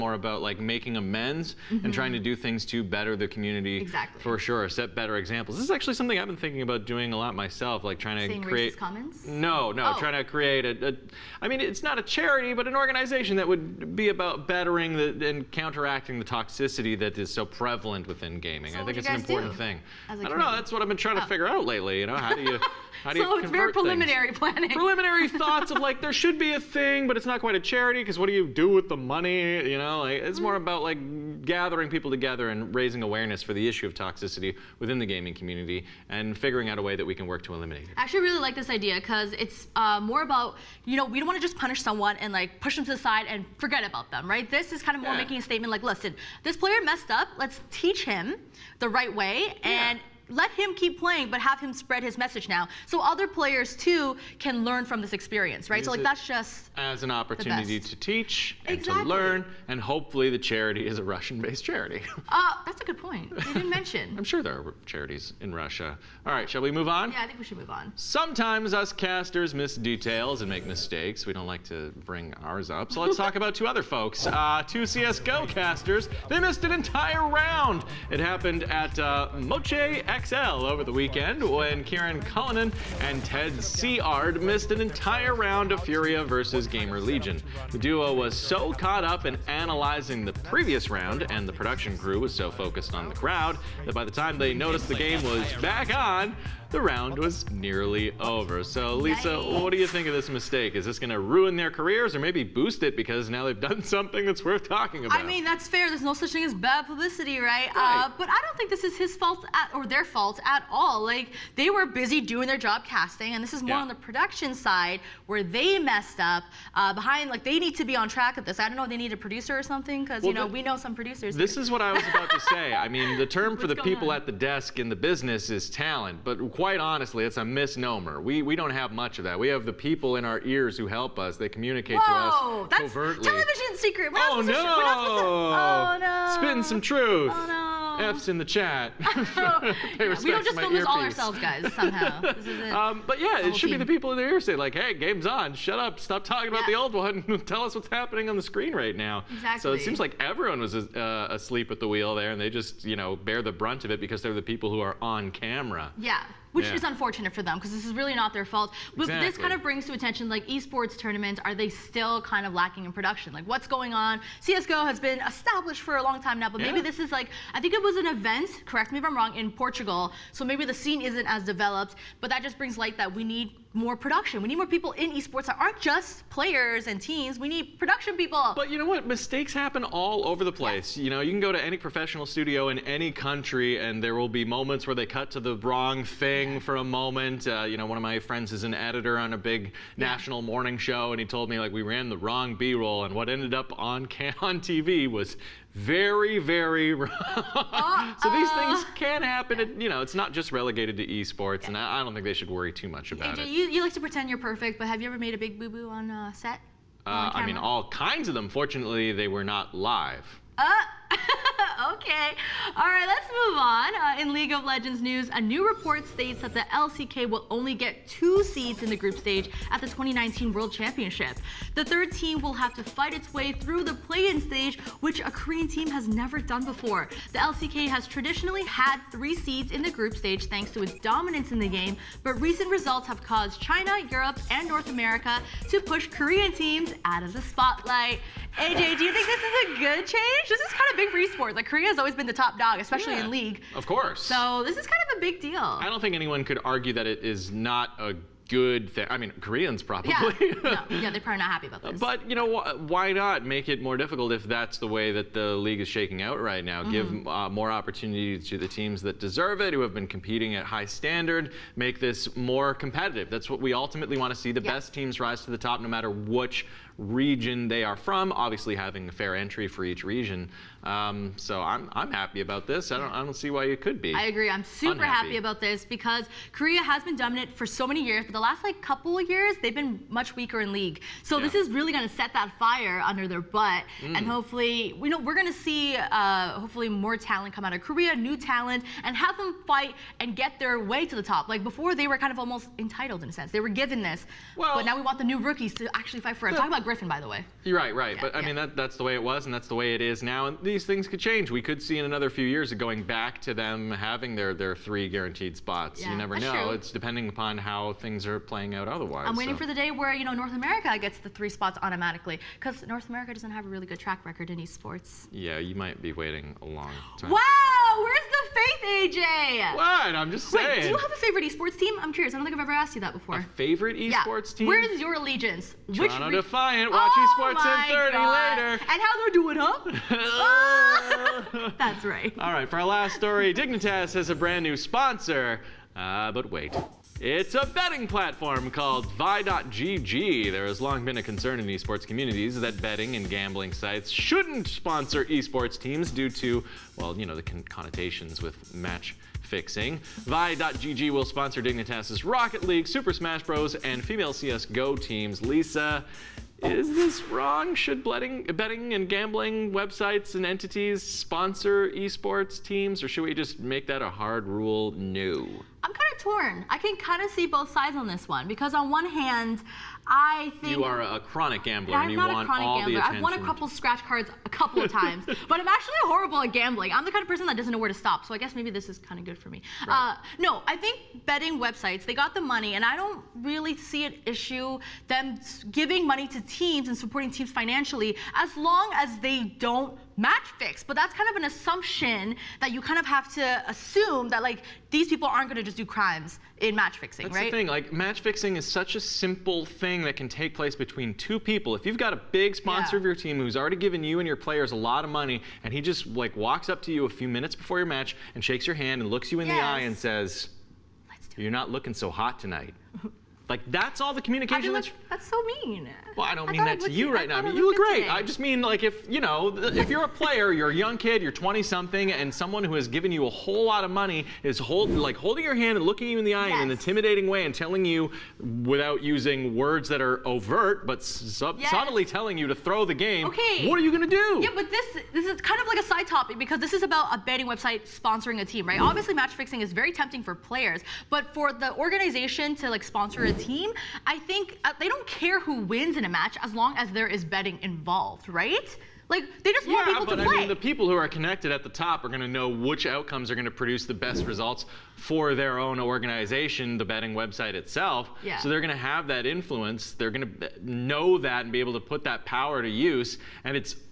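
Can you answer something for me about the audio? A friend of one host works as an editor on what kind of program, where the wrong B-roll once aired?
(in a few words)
national morning show.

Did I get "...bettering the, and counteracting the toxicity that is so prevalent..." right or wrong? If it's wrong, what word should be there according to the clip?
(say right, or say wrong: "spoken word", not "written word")
right.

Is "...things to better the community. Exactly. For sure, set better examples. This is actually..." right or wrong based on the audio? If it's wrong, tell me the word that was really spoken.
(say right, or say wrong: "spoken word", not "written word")
right.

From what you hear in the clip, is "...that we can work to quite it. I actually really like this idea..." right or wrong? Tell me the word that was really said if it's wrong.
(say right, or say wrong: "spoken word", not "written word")
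wrong: "eliminate", not "quite".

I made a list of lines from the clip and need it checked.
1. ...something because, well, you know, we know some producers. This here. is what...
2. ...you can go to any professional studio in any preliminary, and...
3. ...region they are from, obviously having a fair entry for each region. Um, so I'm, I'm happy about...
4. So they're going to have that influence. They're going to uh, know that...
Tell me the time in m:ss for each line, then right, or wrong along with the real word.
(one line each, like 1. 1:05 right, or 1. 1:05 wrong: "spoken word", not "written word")
1. 1:59 right
2. 3:01 wrong: "country", not "preliminary"
3. 4:26 right
4. 7:38 right.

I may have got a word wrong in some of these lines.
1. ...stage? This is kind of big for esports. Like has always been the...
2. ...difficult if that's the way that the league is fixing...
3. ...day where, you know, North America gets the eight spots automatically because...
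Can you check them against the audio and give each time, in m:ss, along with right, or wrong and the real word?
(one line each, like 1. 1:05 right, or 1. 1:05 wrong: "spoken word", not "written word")
1. 4:00 wrong: "change", not "stage"
2. 4:13 wrong: "shaking", not "fixing"
3. 5:09 wrong: "three", not "eight".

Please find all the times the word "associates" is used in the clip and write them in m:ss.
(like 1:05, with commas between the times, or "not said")
not said.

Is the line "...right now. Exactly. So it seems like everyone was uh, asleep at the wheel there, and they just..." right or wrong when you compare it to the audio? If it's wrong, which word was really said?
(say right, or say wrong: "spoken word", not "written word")
right.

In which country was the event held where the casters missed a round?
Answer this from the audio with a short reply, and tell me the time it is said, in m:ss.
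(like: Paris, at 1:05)
Portugal, at 2:49.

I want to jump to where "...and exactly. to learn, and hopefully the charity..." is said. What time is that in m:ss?
0:58.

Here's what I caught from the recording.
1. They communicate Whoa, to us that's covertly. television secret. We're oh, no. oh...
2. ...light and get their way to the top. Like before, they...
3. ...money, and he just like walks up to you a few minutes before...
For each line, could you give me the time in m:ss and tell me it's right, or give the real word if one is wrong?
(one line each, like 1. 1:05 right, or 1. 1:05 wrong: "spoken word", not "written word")
1. 2:11 right
2. 4:49 wrong: "fight", not "light"
3. 6:45 right.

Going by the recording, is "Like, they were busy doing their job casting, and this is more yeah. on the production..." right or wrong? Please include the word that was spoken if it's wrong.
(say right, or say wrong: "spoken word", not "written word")
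right.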